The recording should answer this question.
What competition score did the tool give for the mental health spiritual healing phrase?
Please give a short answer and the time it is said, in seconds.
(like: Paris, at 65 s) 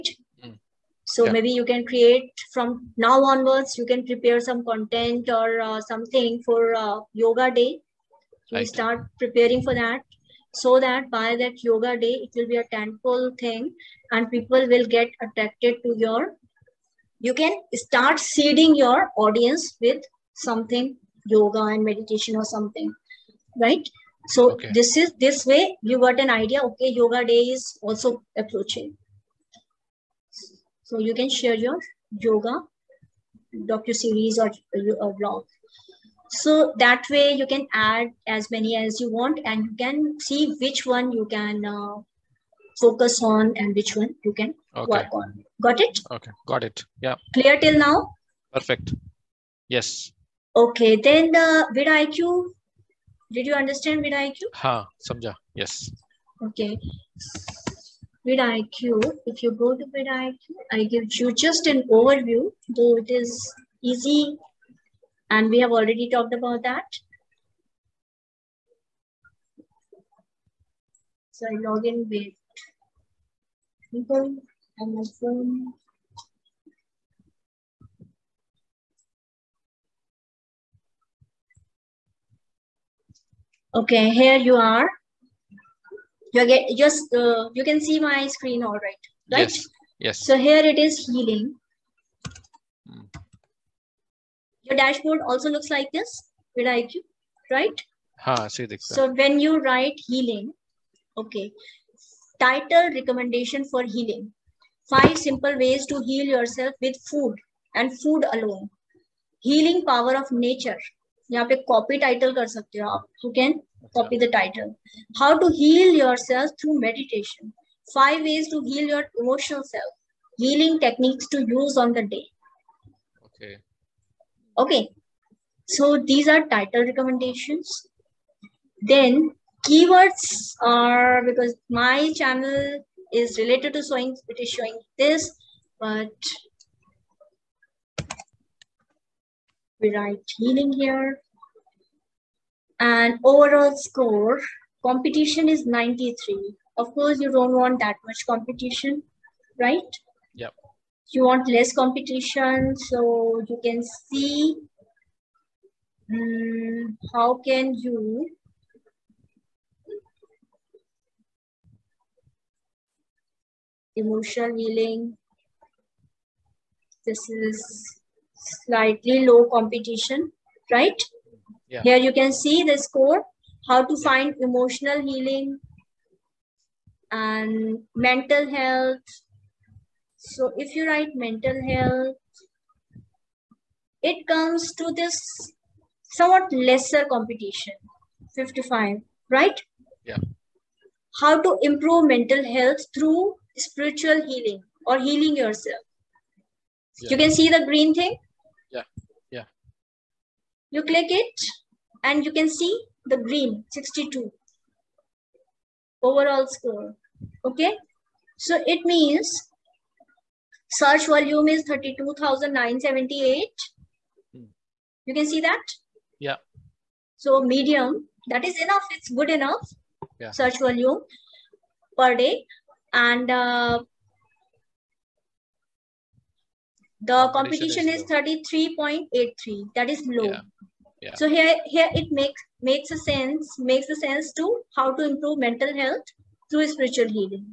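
33.83, at 228 s.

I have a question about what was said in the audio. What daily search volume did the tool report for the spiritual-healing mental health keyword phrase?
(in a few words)
32,978.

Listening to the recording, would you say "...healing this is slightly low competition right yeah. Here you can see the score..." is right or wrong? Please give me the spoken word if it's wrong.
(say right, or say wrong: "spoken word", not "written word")
right.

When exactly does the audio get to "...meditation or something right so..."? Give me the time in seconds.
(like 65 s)
21 s.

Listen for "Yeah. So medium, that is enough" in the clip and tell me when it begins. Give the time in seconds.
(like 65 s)
216 s.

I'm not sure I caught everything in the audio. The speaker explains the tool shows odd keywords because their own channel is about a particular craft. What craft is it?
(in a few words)
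Sewing.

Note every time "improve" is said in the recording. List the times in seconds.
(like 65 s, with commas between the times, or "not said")
191 s, 235 s.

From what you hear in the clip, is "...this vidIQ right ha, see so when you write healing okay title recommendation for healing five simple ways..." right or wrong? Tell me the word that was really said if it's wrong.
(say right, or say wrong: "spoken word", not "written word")
right.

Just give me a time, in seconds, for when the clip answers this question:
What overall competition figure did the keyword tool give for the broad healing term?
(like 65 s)
145 s.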